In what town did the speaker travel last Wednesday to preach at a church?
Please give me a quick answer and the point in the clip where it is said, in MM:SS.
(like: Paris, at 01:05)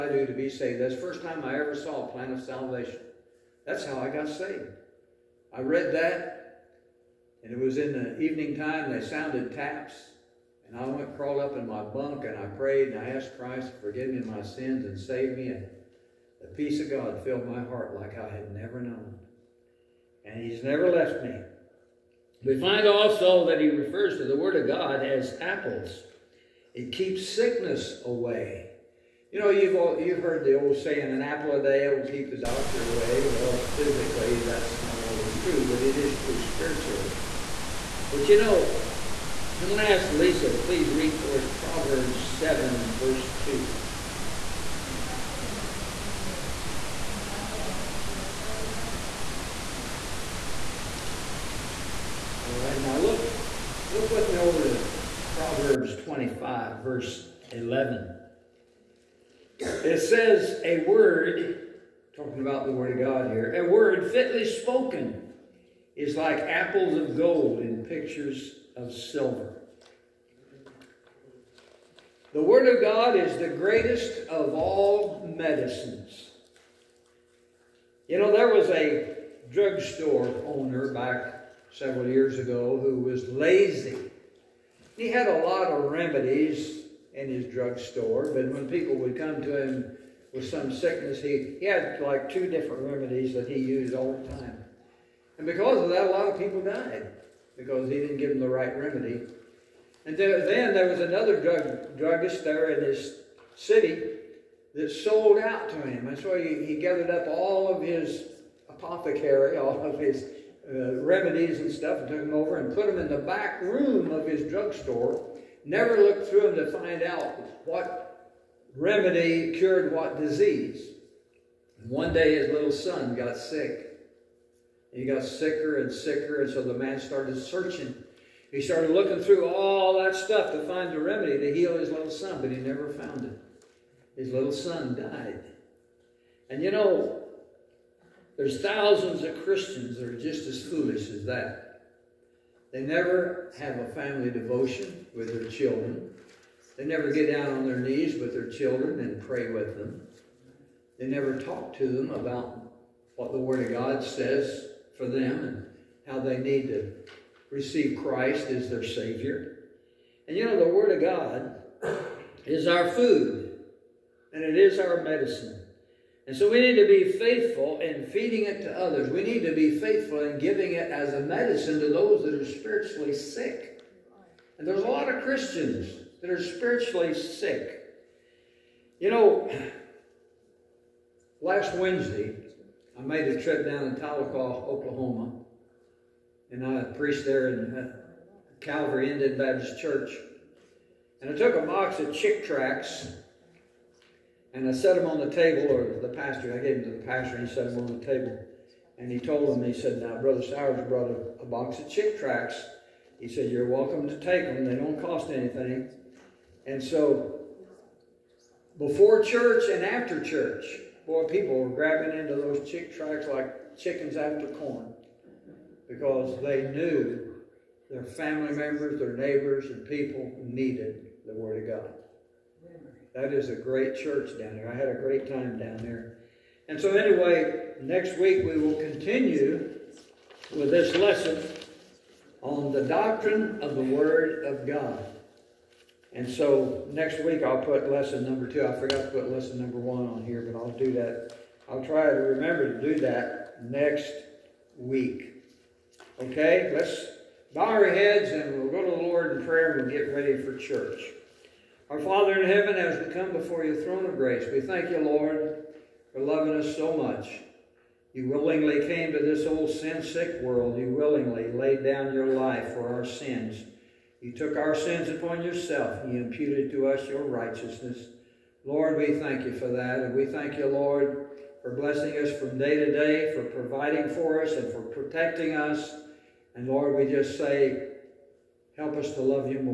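Tahlequah, Oklahoma, at 03:03.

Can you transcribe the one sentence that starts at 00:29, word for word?
You know, you've, all, you've heard the old saying, an apple a day will keep the doctor away.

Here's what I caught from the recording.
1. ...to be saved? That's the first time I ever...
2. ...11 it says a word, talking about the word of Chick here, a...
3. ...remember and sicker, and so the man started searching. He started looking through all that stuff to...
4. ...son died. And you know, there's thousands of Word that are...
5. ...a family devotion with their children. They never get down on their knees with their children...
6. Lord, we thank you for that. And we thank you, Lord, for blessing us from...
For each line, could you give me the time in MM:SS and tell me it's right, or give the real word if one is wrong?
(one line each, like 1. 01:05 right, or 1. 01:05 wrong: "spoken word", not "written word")
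1. 00:00 right
2. 00:57 wrong: "God", not "Chick"
3. 02:05 wrong: "sicker", not "remember"
4. 02:14 wrong: "Christians", not "Word"
5. 02:23 right
6. 04:28 right.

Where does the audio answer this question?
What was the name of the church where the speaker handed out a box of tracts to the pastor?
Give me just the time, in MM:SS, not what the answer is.
03:08.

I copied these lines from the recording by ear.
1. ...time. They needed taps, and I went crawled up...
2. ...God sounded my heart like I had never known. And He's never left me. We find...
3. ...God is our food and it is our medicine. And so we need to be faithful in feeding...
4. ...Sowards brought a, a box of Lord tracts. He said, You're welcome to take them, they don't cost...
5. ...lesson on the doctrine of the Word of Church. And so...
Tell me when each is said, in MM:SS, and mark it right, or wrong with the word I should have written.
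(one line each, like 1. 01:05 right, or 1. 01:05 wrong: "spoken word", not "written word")
1. 00:08 wrong: "sounded", not "needed"
2. 00:16 wrong: "filled", not "sounded"
3. 02:41 right
4. 03:20 wrong: "Chick", not "Lord"
5. 03:50 wrong: "God", not "Church".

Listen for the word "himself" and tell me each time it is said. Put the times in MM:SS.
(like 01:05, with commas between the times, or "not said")
not said.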